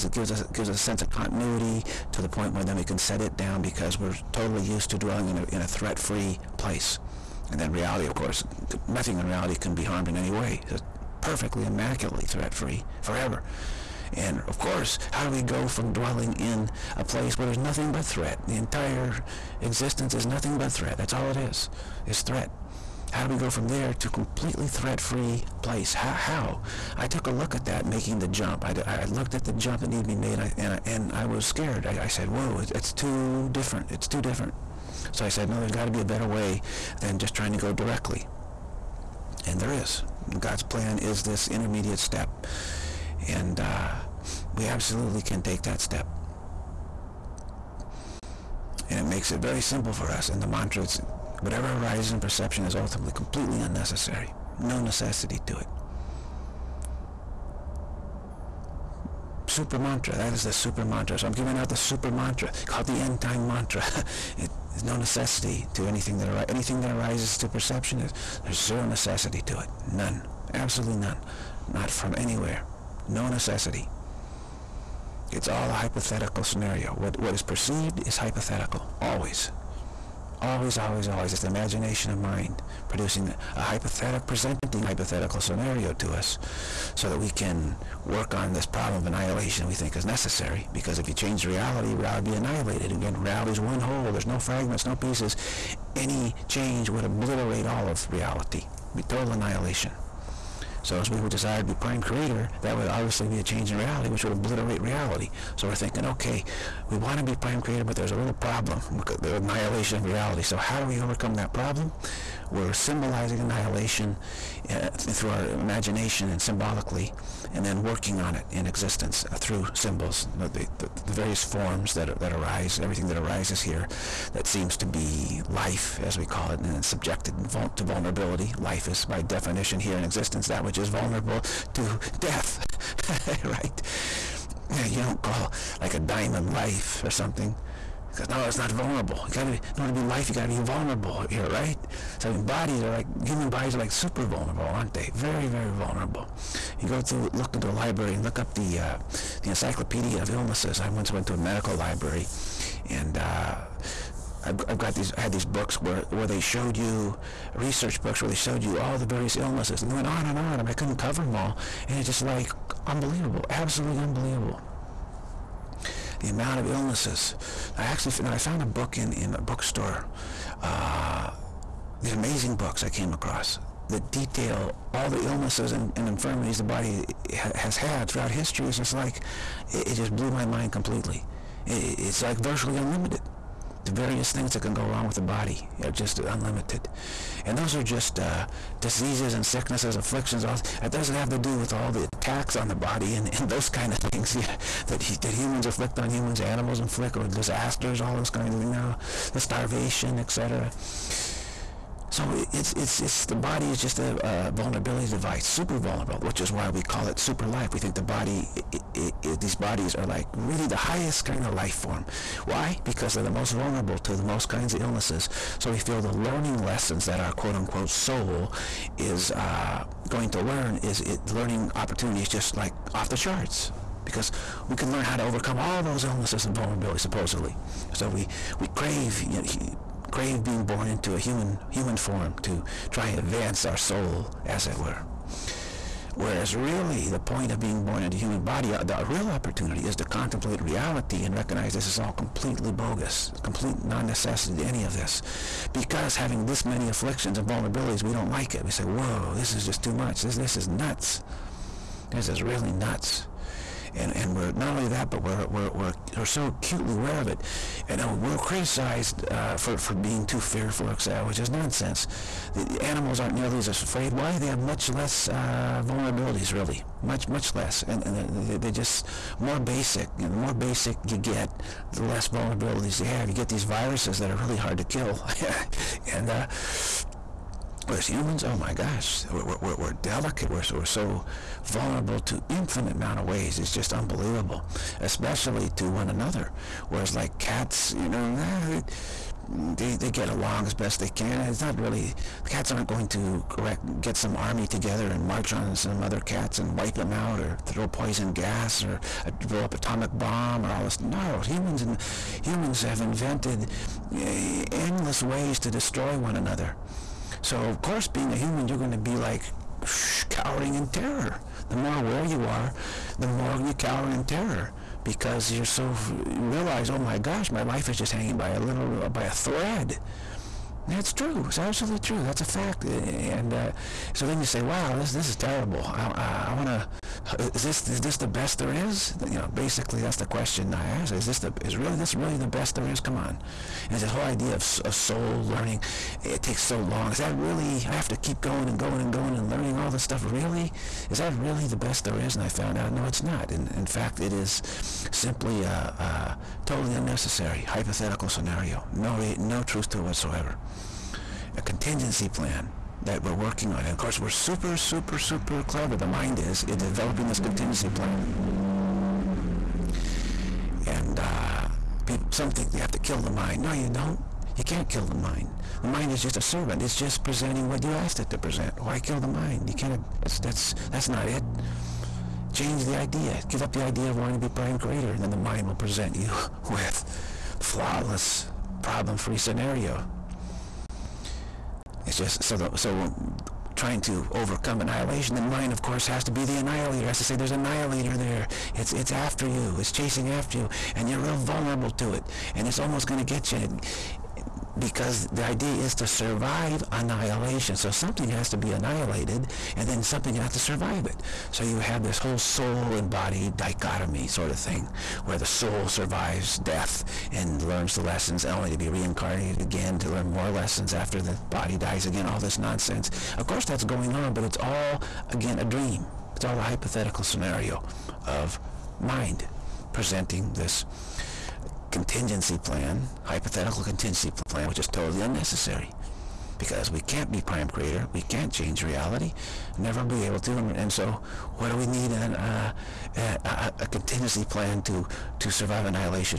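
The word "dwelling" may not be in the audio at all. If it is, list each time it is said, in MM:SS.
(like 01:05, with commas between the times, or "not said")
00:04, 00:15.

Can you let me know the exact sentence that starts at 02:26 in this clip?
You go through, look into a library and look up the, uh, the encyclopedia of illnesses.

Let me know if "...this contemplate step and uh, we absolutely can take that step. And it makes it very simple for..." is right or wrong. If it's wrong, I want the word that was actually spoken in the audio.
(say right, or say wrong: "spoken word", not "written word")
wrong: "intermediate", not "contemplate".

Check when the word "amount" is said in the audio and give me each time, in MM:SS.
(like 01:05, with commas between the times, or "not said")
02:46, 04:42.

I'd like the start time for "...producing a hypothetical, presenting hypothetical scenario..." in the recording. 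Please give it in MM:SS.
01:22.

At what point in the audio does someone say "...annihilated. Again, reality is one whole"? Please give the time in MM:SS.
01:32.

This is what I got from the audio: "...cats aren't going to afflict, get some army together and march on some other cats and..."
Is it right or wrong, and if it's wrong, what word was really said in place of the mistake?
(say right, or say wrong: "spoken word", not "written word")
wrong: "correct", not "afflict".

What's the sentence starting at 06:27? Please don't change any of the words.
Has to say there's an annihilator there.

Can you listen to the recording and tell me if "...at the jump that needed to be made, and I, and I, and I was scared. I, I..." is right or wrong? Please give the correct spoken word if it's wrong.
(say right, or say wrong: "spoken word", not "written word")
right.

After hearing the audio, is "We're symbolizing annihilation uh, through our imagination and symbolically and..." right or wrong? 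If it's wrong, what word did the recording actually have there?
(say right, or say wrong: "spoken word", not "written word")
right.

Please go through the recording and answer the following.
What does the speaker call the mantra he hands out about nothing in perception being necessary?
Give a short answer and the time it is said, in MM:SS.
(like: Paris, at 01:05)
end time mantra, at 01:02.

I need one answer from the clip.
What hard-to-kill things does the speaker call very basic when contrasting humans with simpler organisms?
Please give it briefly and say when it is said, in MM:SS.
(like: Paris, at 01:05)
viruses, at 04:33.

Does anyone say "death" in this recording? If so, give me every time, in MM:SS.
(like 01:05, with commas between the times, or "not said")
02:12, 06:46.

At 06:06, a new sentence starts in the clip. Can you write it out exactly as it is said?
It's just presenting what you asked it to present.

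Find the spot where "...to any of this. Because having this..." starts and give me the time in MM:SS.
04:04.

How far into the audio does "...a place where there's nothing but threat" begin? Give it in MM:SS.
00:16.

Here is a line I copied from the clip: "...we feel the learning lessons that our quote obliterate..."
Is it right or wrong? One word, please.
wrong.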